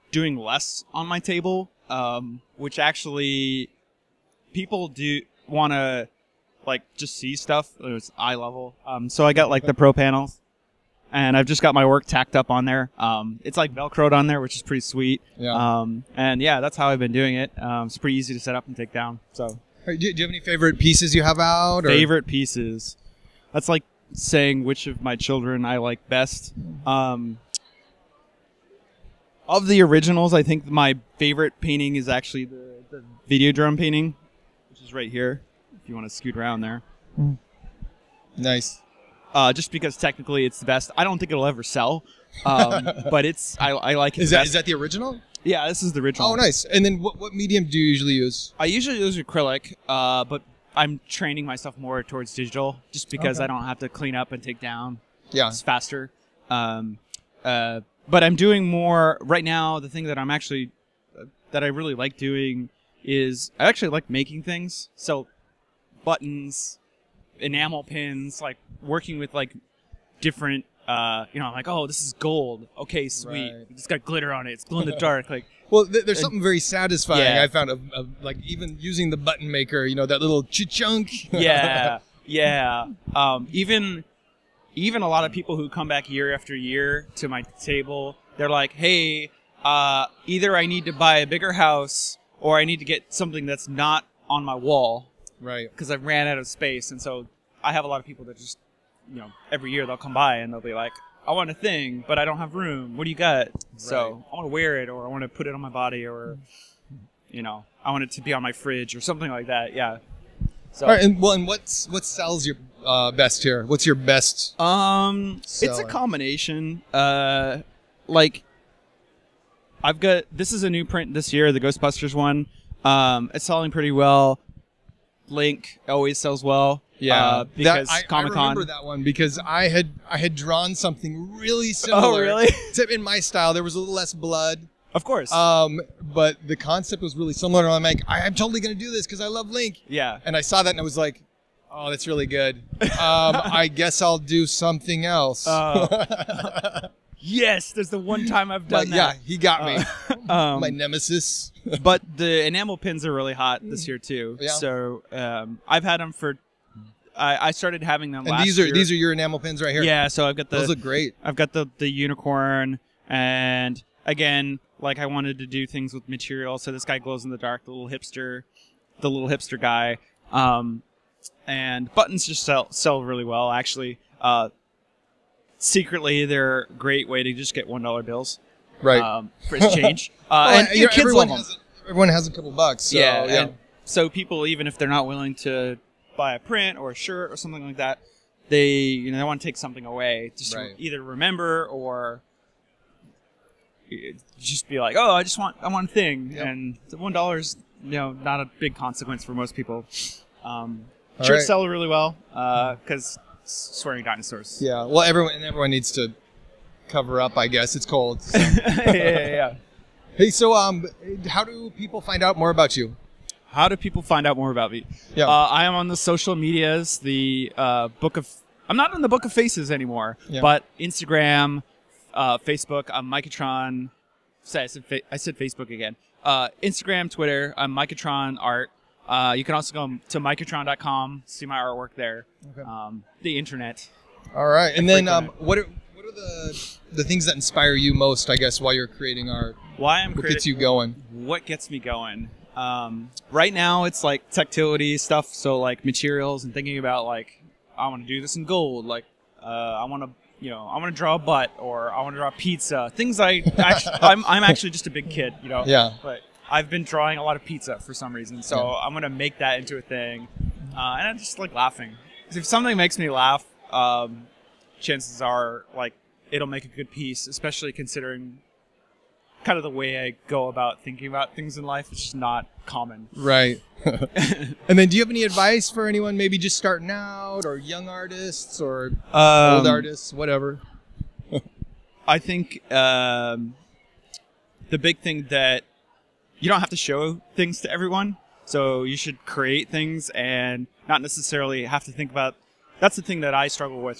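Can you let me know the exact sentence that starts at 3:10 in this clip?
either remember or just be like, oh, I just want I want a thing, yep.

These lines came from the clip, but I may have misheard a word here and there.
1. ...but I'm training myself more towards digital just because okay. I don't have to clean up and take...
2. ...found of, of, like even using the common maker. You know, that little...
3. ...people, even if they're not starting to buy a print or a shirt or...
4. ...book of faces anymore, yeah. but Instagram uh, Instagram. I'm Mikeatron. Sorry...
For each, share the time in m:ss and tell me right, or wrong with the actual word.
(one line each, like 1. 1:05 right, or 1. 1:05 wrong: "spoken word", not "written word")
1. 0:50 right
2. 1:17 wrong: "button", not "common"
3. 3:04 wrong: "willing", not "starting"
4. 3:39 wrong: "Facebook", not "Instagram".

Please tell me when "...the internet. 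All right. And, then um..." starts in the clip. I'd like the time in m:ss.
3:53.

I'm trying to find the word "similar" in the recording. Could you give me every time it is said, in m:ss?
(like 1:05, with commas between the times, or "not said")
2:11, 2:17.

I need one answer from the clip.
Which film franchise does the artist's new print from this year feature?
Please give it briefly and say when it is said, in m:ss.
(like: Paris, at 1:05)
Ghostbusters, at 2:01.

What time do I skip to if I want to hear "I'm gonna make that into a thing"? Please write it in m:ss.
4:18.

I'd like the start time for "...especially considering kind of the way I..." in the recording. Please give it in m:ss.
4:27.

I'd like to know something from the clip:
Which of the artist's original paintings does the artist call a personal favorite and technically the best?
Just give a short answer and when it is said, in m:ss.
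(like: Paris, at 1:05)
The video drum painting, at 0:33.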